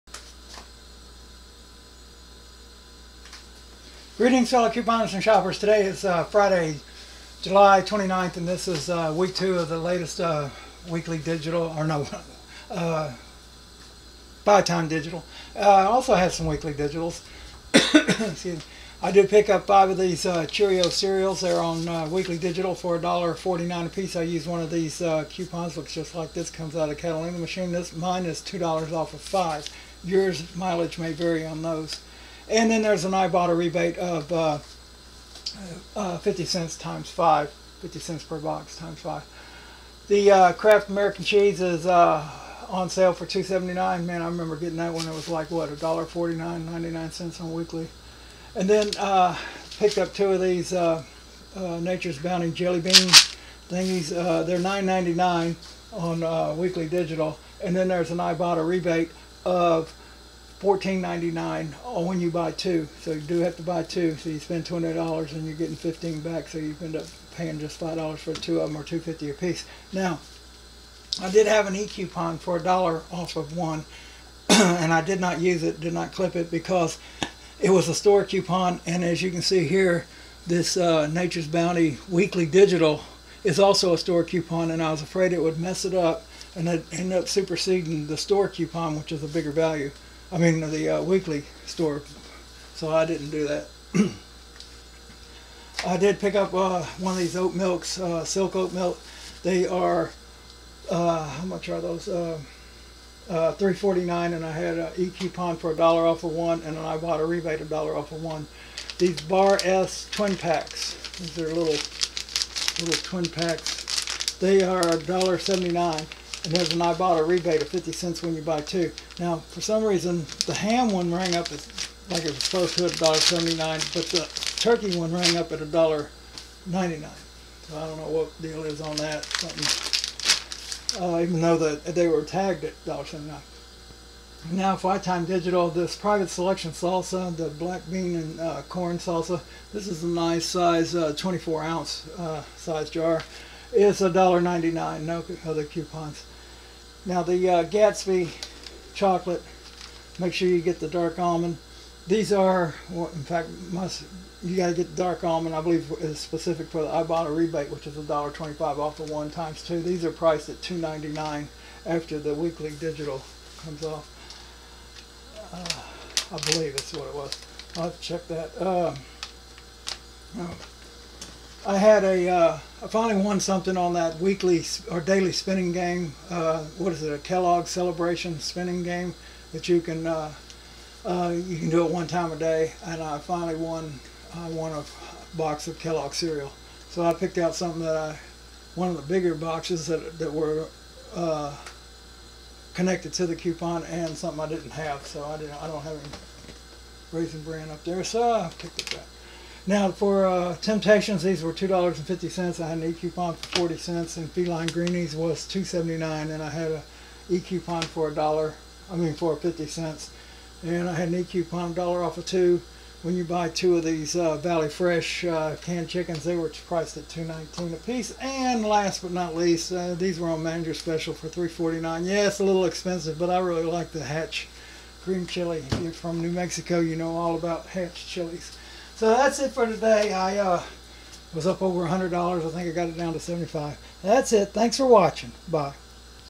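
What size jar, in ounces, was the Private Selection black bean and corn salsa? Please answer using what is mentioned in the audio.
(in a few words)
24 ounce.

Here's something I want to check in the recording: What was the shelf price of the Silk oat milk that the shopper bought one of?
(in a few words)
$3.49.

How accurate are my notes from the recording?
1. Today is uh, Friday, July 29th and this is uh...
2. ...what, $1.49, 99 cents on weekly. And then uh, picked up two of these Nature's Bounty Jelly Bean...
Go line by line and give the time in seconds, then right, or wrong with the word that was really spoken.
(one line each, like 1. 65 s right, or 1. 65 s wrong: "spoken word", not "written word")
1. 5 s right
2. 45 s right.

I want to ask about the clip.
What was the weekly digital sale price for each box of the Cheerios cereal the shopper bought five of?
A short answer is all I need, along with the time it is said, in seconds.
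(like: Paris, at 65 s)
$1.49, at 22 s.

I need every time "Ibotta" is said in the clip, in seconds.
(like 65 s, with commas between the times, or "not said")
33 s, 58 s, 116 s, 156 s.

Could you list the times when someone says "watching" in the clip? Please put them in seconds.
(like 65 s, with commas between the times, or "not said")
234 s.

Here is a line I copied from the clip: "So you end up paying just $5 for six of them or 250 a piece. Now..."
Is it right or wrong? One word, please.
wrong.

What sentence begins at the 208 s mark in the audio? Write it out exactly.
I mean for fifty cents, and I had an e-coupon dollar off of two.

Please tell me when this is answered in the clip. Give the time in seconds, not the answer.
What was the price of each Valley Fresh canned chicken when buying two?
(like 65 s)
217 s.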